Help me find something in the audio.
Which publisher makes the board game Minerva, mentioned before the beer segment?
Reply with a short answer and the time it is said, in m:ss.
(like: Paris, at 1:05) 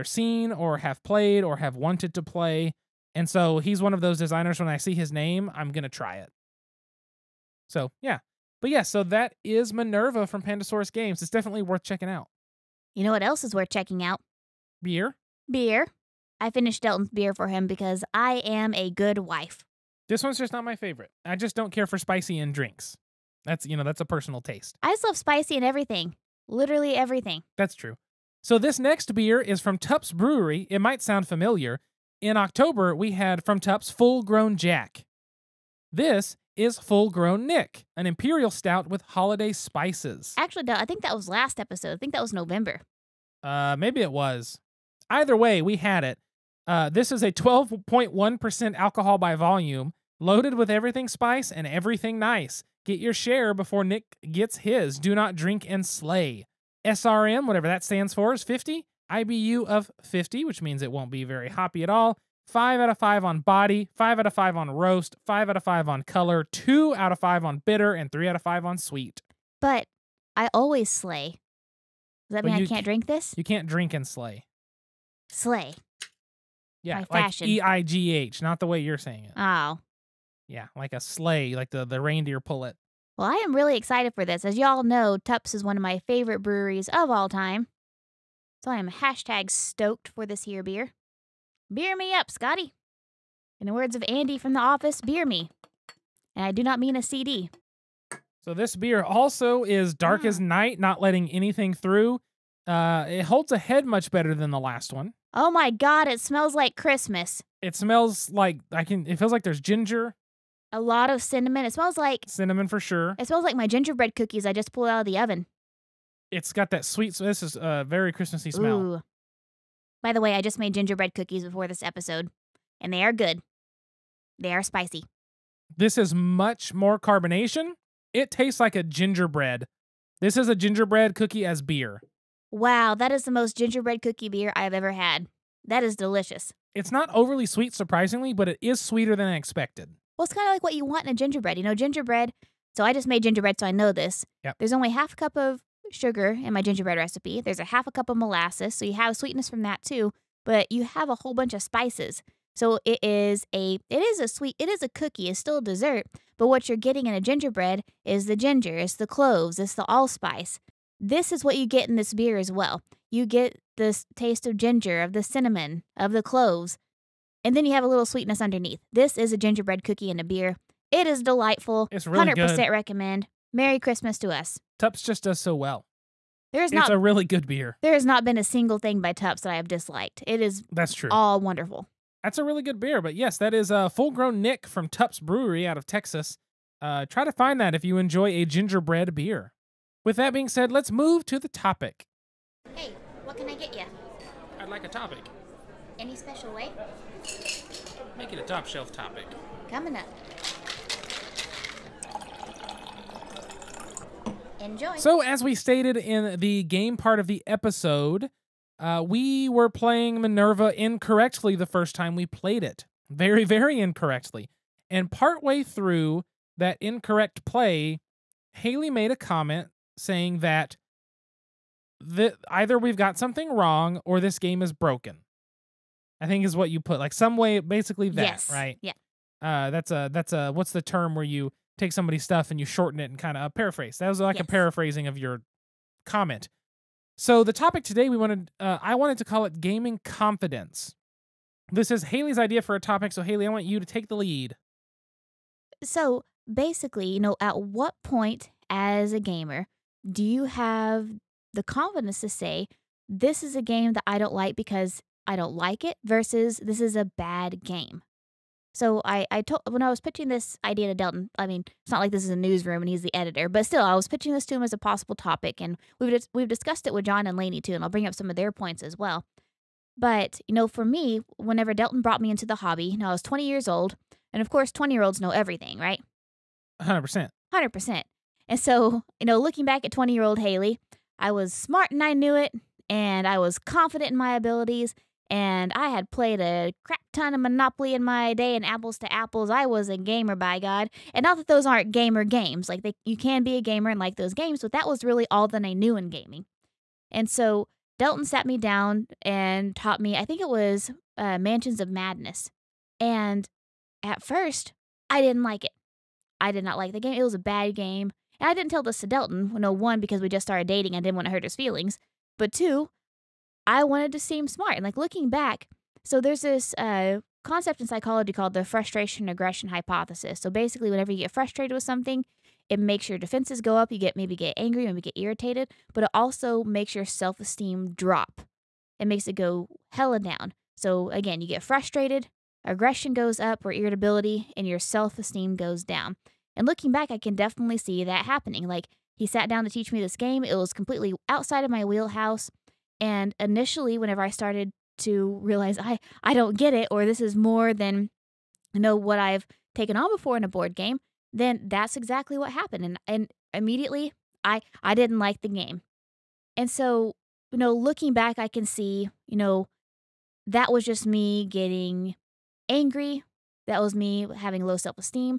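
Pandasaurus Games, at 0:10.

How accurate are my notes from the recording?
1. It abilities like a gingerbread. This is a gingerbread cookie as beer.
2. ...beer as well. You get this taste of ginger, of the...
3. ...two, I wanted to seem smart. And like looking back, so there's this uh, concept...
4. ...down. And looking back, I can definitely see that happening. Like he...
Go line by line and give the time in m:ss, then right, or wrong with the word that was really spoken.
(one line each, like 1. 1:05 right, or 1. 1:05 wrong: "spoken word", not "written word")
1. 2:08 wrong: "tastes", not "abilities"
2. 2:42 right
3. 5:12 right
4. 5:35 right.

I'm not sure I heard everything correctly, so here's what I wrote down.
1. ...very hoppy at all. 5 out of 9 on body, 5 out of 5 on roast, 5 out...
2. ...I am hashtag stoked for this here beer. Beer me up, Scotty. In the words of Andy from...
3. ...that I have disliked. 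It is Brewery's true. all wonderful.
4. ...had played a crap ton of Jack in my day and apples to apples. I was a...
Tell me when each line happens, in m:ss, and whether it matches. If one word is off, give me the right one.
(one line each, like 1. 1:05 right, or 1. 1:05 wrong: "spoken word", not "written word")
1. 1:01 wrong: "5", not "9"
2. 1:28 right
3. 2:59 wrong: "That", not "Brewery"
4. 4:45 wrong: "Monopoly", not "Jack".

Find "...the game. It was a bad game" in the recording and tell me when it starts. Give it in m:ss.
5:06.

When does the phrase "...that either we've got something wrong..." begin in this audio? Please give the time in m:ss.
3:40.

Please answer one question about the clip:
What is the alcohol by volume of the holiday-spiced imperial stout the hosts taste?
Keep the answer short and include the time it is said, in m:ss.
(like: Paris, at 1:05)
12.1%, at 0:47.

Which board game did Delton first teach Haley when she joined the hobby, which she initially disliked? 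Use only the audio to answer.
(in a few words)
Mansions of Madness.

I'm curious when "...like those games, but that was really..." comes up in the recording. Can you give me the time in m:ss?
4:53.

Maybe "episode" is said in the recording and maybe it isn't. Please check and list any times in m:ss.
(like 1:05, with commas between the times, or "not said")
0:41, 2:01, 3:27.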